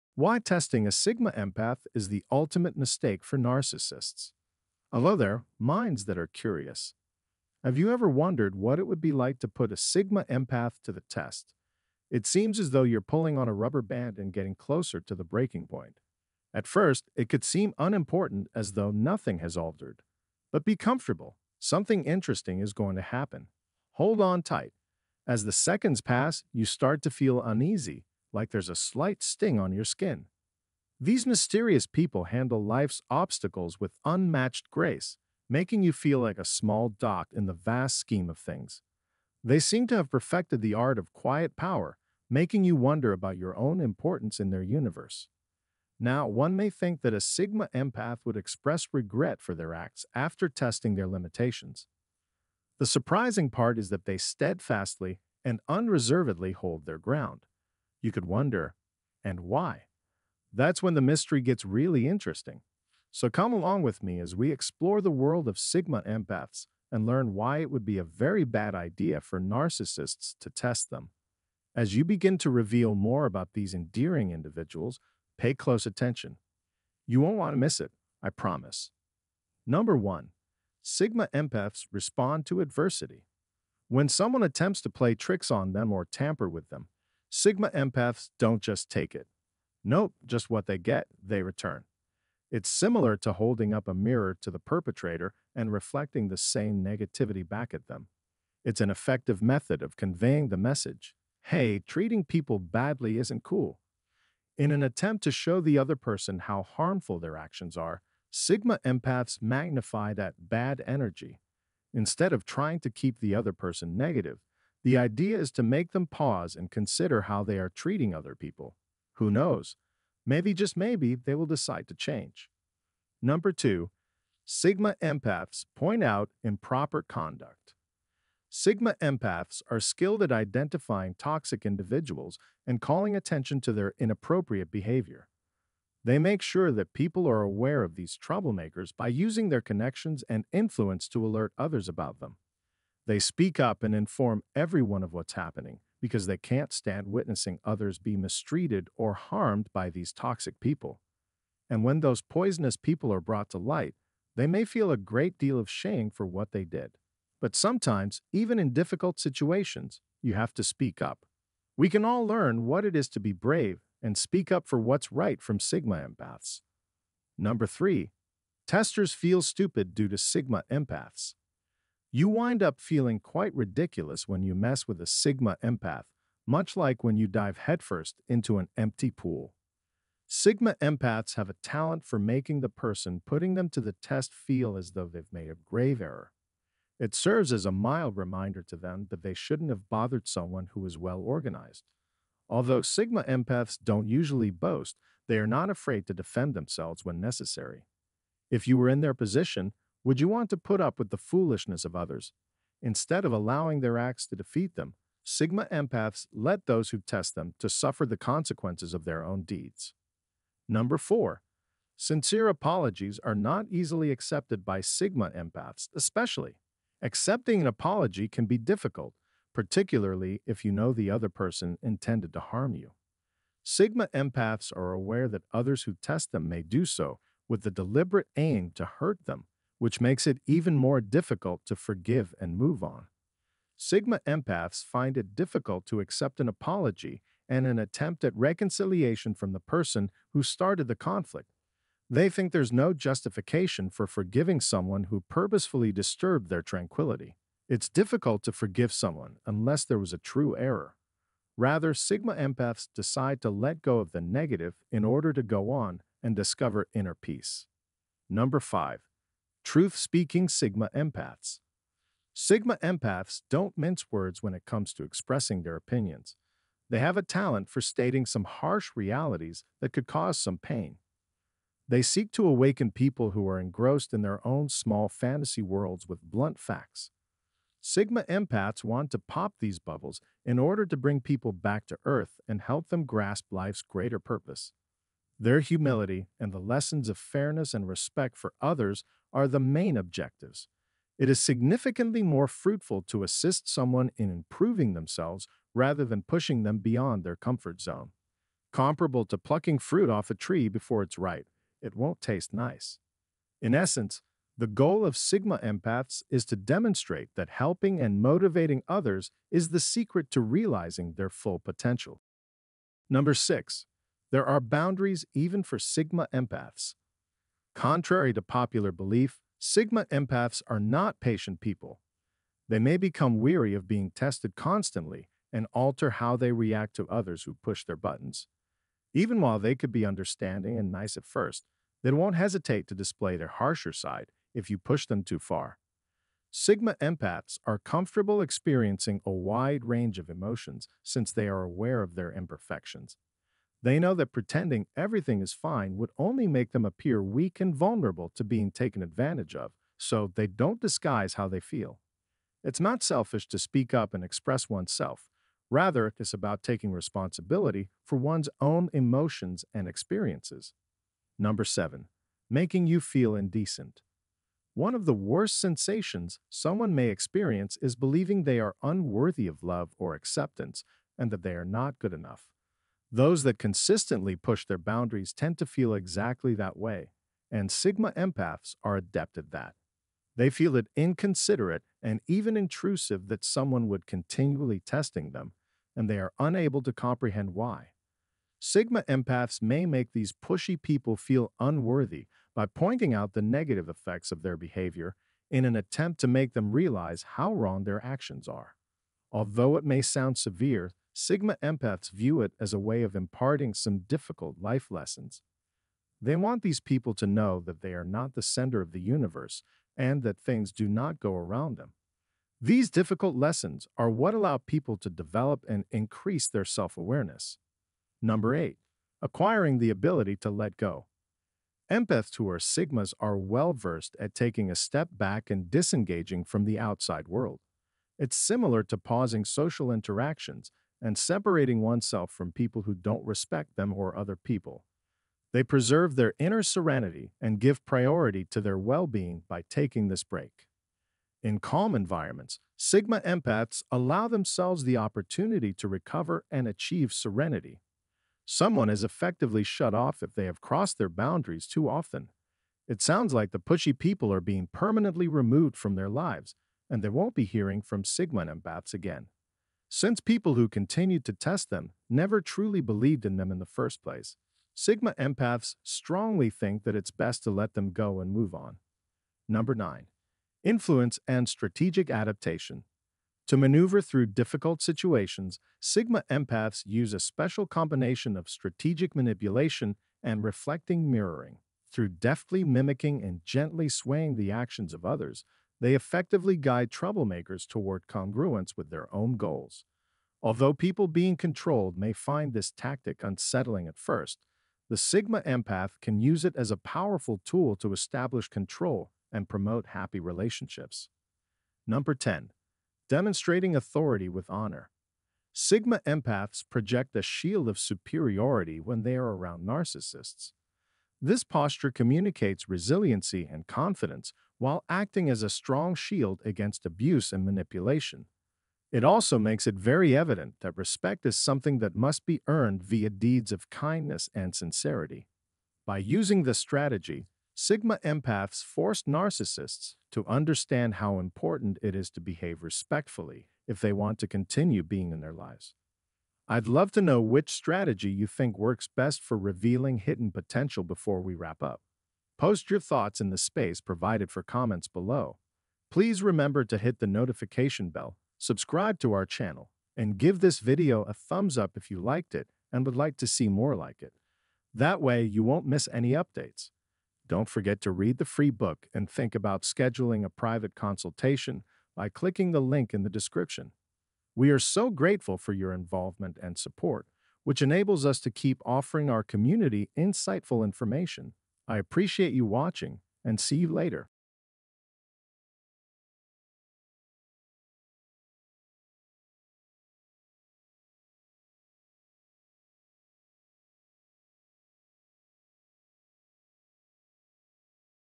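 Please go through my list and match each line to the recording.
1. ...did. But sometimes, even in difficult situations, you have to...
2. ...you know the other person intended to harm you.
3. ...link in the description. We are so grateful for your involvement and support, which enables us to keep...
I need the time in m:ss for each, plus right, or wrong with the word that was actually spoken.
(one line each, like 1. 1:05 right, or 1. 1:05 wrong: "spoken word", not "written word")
1. 2:36 right
2. 3:40 right
3. 9:22 right.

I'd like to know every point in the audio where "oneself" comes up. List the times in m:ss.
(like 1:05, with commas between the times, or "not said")
5:54, 7:11.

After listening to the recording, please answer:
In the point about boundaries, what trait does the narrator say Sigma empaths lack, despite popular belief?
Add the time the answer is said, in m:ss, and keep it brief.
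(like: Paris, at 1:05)
patient, at 5:21.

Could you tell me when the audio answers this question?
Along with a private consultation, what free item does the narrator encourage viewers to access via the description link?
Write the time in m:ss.
9:18.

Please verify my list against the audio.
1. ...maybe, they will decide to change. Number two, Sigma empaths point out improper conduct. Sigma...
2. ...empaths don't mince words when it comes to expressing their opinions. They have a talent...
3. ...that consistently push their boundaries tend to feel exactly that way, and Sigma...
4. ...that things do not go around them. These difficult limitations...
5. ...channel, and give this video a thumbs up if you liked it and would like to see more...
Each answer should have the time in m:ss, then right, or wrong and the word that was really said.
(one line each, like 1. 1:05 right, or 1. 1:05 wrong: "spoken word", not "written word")
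1. 2:00 right
2. 4:22 right
3. 6:13 right
4. 6:50 wrong: "lessons", not "limitations"
5. 9:09 right.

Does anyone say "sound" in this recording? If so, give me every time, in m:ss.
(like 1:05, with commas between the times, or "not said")
6:40, 7:33.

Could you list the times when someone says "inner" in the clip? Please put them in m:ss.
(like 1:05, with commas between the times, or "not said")
4:16, 7:16.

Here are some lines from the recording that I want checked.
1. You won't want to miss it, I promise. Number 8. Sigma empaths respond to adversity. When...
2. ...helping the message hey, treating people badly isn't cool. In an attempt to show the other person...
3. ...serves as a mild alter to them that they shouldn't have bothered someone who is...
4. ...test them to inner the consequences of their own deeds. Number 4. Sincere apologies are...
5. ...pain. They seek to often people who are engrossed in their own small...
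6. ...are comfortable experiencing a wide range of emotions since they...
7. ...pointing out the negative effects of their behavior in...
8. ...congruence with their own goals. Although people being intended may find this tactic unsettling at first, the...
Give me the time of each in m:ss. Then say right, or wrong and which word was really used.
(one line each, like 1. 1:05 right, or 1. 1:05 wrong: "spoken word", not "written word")
1. 1:17 wrong: "1", not "8"
2. 1:39 wrong: "conveying", not "helping"
3. 3:07 wrong: "reminder", not "alter"
4. 3:26 wrong: "suffer", not "inner"
5. 4:30 wrong: "awaken", not "often"
6. 5:37 right
7. 6:32 right
8. 8:08 wrong: "controlled", not "intended".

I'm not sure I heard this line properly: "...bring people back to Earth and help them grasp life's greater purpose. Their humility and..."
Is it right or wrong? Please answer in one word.
right.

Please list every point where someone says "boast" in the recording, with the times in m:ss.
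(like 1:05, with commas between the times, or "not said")
3:14.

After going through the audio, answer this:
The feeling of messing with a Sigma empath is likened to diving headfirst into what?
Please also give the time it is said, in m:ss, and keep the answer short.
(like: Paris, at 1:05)
an empty pool, at 2:58.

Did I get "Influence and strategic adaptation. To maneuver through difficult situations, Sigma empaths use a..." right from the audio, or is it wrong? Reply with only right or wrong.
right.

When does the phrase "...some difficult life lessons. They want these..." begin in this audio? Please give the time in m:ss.
6:43.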